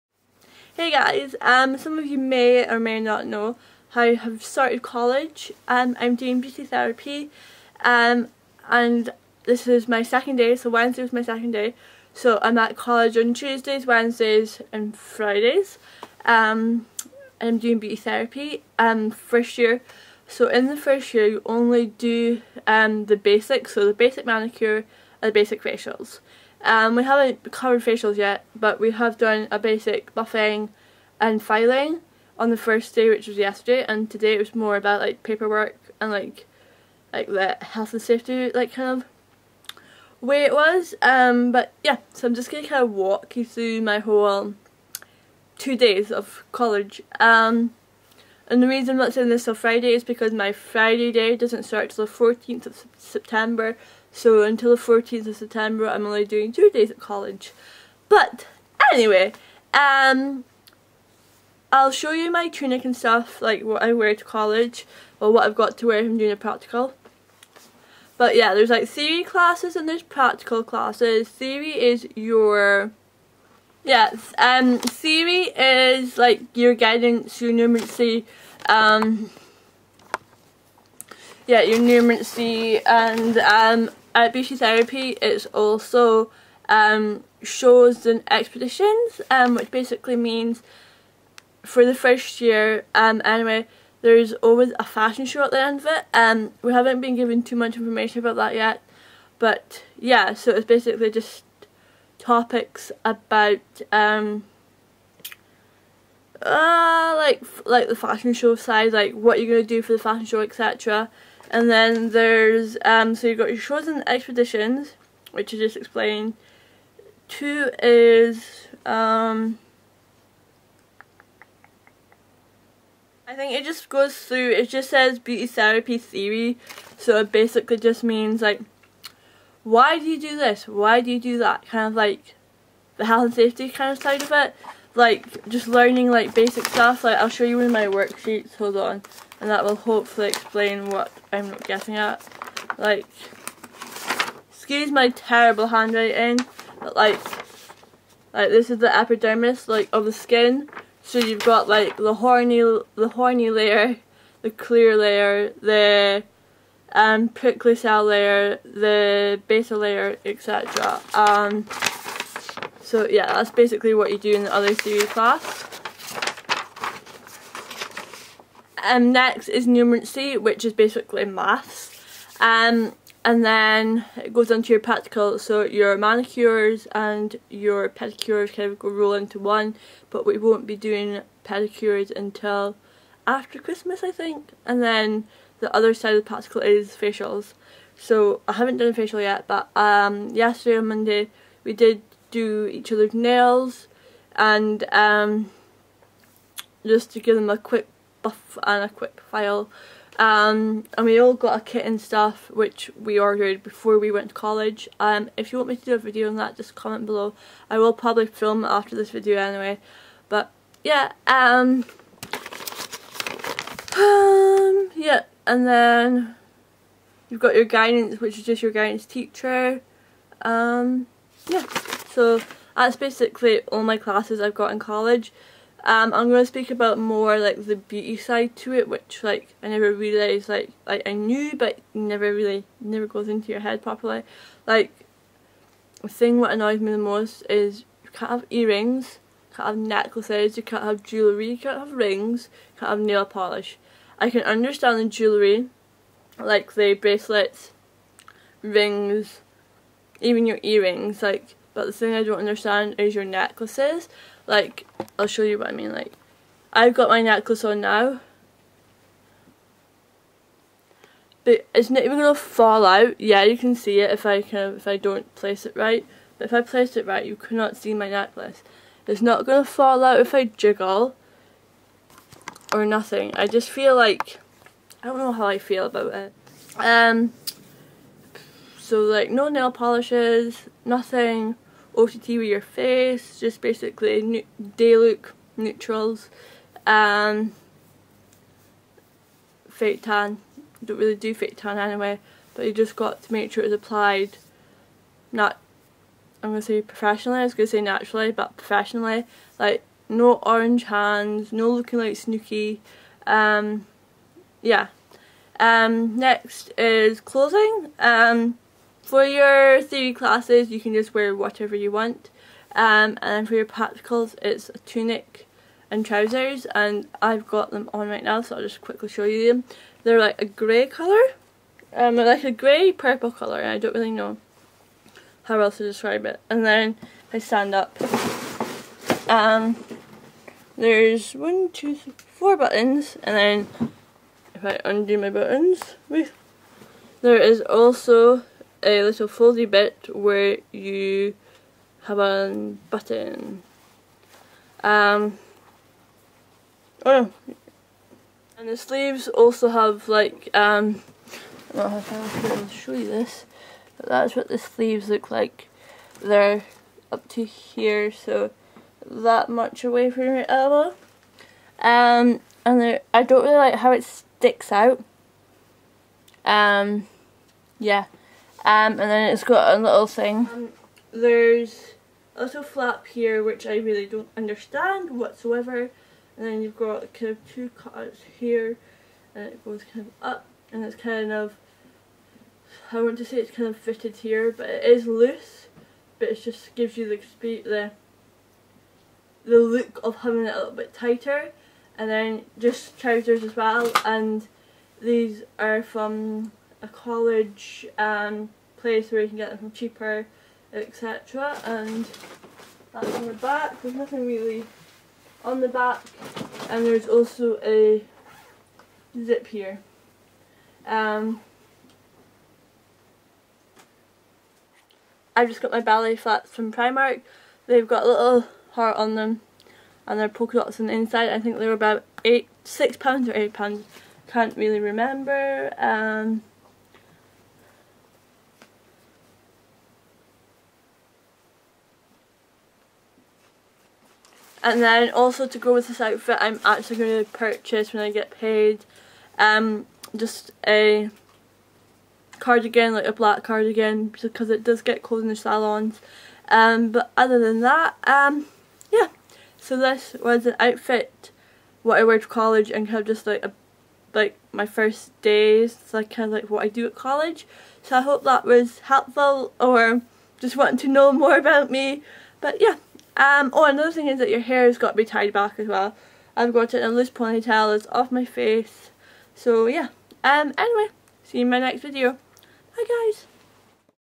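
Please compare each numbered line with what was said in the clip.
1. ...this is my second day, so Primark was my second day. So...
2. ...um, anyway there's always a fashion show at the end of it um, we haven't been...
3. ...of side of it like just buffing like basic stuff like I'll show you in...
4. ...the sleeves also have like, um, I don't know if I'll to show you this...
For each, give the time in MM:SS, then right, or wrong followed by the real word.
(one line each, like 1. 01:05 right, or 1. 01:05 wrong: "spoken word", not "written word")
1. 00:09 wrong: "Wednesday", not "Primark"
2. 01:32 right
3. 02:13 wrong: "learning", not "buffing"
4. 05:48 right.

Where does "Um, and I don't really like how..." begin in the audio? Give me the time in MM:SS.
06:01.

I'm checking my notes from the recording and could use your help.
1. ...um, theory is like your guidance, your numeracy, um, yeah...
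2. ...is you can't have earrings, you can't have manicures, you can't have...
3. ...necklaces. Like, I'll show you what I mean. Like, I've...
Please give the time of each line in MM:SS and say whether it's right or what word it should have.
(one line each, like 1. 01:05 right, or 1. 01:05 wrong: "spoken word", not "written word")
1. 01:14 right
2. 03:57 wrong: "necklaces", not "manicures"
3. 04:13 right.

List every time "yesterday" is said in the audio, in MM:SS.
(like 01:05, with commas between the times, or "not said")
00:33, 03:10.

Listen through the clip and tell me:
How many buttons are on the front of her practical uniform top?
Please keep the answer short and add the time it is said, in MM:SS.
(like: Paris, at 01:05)
4, at 05:32.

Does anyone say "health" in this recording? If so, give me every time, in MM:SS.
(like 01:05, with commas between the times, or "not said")
00:37, 02:13.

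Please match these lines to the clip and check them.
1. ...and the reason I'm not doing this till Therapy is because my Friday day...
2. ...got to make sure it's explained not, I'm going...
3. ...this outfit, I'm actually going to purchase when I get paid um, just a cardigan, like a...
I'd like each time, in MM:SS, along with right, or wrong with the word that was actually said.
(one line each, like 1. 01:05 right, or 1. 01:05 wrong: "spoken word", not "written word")
1. 00:48 wrong: "Friday", not "Therapy"
2. 04:52 wrong: "applied", not "explained"
3. 07:15 right.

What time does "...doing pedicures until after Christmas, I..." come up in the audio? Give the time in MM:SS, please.
03:00.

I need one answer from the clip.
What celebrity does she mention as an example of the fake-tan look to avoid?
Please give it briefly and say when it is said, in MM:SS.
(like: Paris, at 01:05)
Snooki, at 05:02.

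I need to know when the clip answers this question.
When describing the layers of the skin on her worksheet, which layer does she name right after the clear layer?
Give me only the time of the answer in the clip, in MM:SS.
02:37.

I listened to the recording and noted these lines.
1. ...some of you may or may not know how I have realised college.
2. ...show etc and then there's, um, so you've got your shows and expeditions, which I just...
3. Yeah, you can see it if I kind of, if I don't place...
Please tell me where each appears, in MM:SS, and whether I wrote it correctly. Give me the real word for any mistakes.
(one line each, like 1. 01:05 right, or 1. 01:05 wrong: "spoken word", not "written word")
1. 00:01 wrong: "started", not "realised"
2. 01:50 right
3. 04:23 right.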